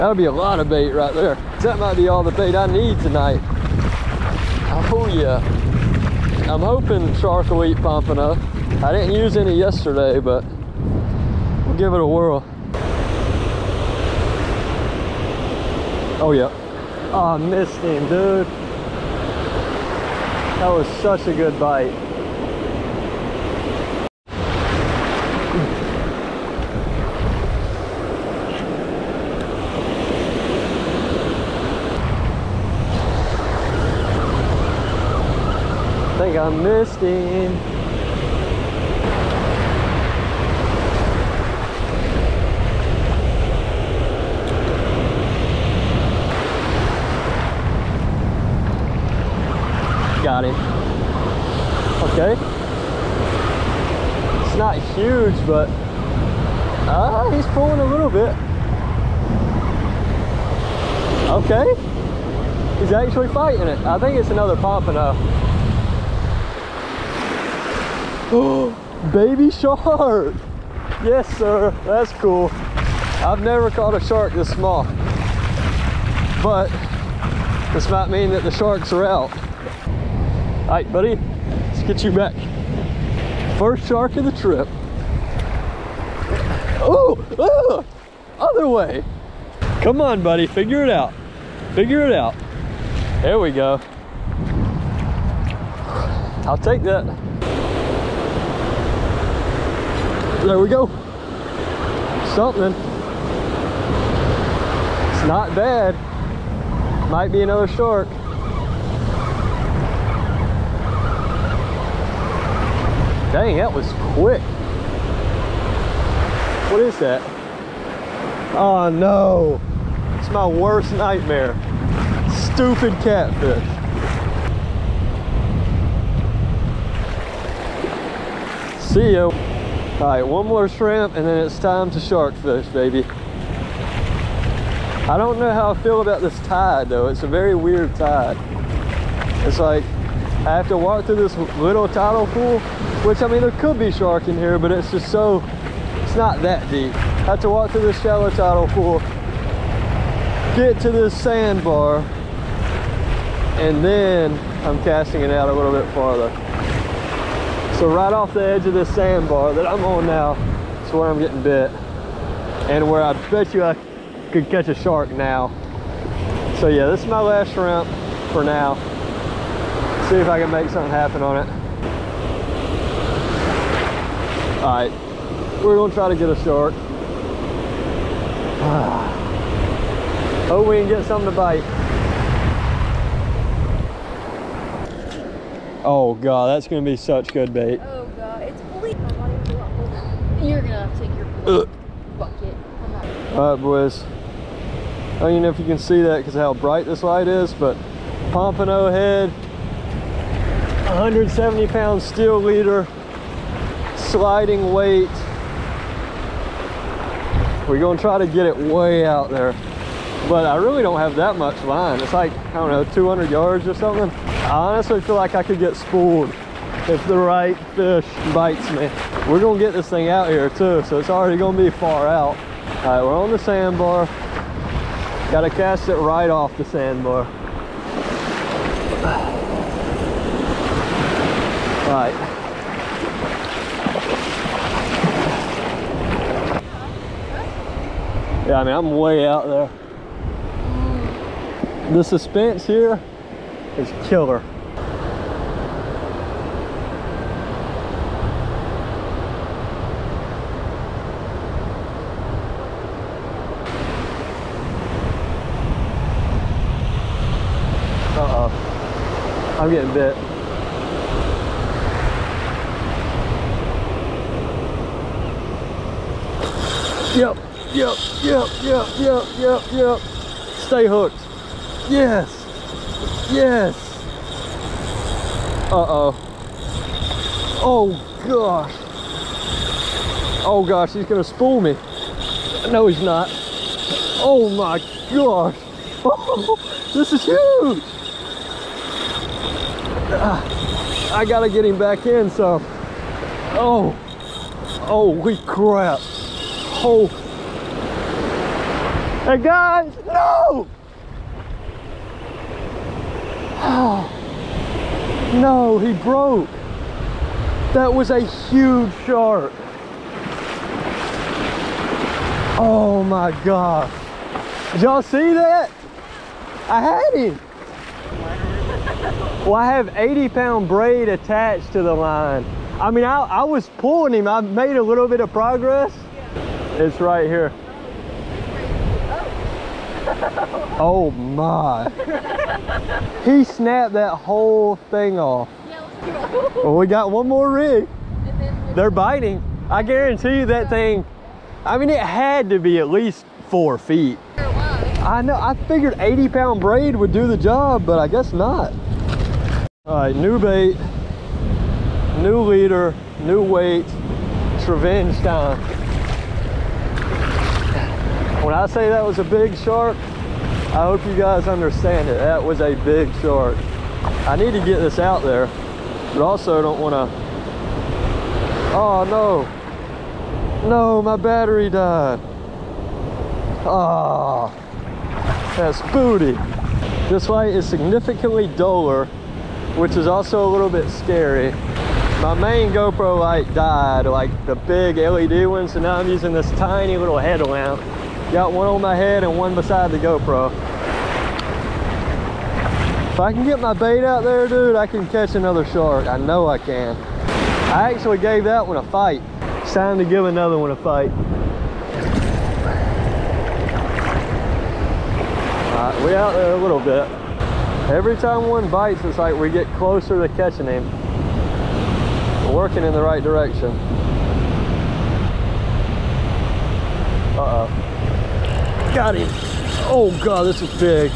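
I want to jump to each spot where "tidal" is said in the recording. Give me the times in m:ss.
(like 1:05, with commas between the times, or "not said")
2:21, 2:28.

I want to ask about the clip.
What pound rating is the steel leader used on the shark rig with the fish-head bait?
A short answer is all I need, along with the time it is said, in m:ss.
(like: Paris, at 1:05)
170, at 3:20.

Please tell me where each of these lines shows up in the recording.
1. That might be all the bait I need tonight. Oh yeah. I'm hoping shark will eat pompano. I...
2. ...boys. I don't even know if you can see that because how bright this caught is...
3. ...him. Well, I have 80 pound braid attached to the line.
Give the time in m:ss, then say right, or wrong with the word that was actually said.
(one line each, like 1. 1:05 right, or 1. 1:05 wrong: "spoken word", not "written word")
1. 0:01 right
2. 3:13 wrong: "light", not "caught"
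3. 5:17 right.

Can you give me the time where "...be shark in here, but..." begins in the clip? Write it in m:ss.
2:23.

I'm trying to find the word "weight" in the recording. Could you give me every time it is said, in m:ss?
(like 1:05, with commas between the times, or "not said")
3:24, 5:53.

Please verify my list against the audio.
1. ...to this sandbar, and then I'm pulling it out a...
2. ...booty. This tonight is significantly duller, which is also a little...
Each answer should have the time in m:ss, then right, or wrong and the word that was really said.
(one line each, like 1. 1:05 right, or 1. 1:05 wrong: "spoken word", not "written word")
1. 2:30 wrong: "casting", not "pulling"
2. 6:15 wrong: "light", not "tonight".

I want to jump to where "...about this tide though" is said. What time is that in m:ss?
2:16.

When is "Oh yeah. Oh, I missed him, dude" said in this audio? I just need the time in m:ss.
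0:16.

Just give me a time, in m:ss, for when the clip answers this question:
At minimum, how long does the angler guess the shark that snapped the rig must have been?
5:43.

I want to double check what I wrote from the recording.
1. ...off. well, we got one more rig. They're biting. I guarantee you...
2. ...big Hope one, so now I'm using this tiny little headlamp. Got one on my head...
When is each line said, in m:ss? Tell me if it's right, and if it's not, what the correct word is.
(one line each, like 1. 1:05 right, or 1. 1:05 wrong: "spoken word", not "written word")
1. 5:35 right
2. 6:24 wrong: "LED", not "Hope".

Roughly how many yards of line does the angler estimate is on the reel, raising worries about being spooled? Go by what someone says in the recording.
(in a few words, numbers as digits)
200.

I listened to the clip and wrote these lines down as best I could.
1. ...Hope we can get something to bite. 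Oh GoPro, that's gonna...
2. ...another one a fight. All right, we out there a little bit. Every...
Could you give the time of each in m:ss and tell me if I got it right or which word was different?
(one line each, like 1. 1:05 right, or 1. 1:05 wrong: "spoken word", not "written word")
1. 3:00 wrong: "God", not "GoPro"
2. 6:40 right.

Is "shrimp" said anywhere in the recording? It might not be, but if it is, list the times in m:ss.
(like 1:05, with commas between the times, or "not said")
2:10, 2:47.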